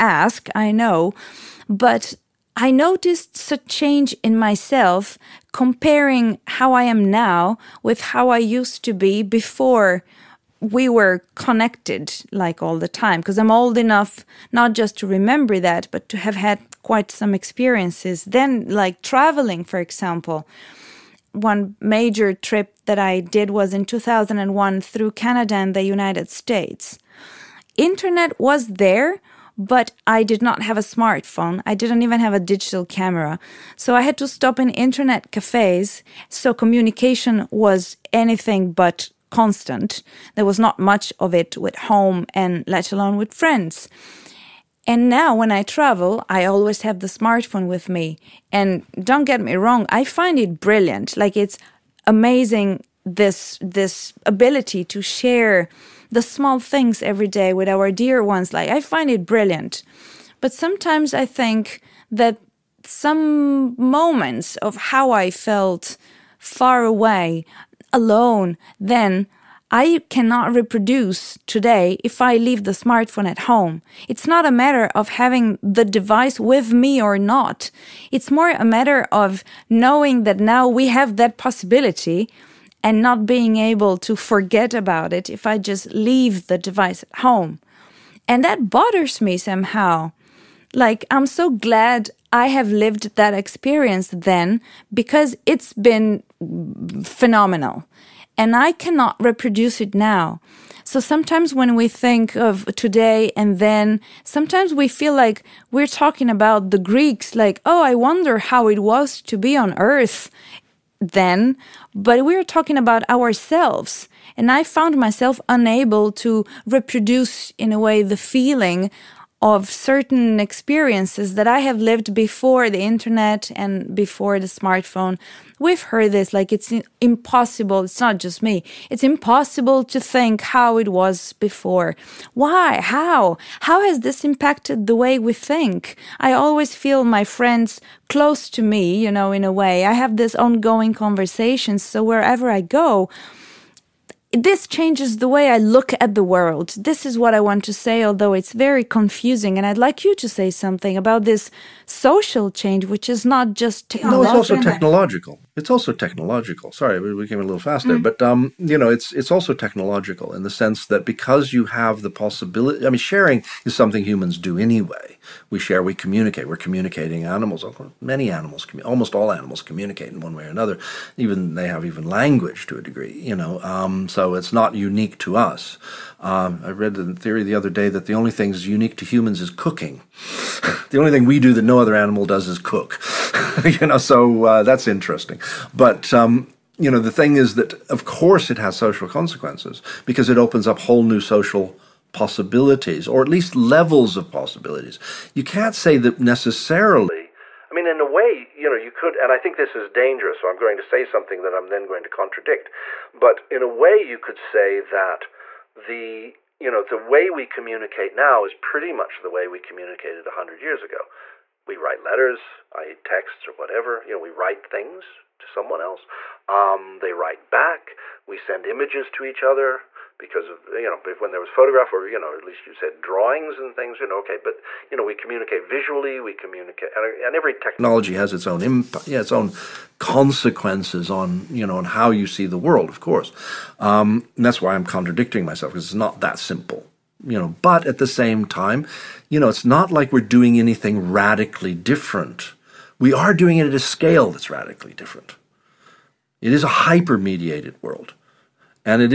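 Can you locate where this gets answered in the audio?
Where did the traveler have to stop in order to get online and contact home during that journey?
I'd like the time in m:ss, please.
0:34.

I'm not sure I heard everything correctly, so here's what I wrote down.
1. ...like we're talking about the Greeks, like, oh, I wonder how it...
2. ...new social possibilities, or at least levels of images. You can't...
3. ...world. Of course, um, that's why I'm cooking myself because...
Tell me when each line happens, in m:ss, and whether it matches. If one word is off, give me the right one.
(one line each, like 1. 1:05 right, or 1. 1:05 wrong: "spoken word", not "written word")
1. 1:45 right
2. 3:11 wrong: "possibilities", not "images"
3. 3:52 wrong: "contradicting", not "cooking".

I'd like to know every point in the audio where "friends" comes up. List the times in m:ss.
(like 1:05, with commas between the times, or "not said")
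0:43, 2:17.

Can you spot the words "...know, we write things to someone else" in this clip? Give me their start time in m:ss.
3:34.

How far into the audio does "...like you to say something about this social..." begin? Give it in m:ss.
2:29.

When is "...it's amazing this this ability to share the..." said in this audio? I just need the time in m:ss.
0:51.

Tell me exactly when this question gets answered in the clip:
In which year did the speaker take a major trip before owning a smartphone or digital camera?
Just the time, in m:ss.
0:23.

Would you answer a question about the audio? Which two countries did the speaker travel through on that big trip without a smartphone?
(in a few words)
Canada and the United States.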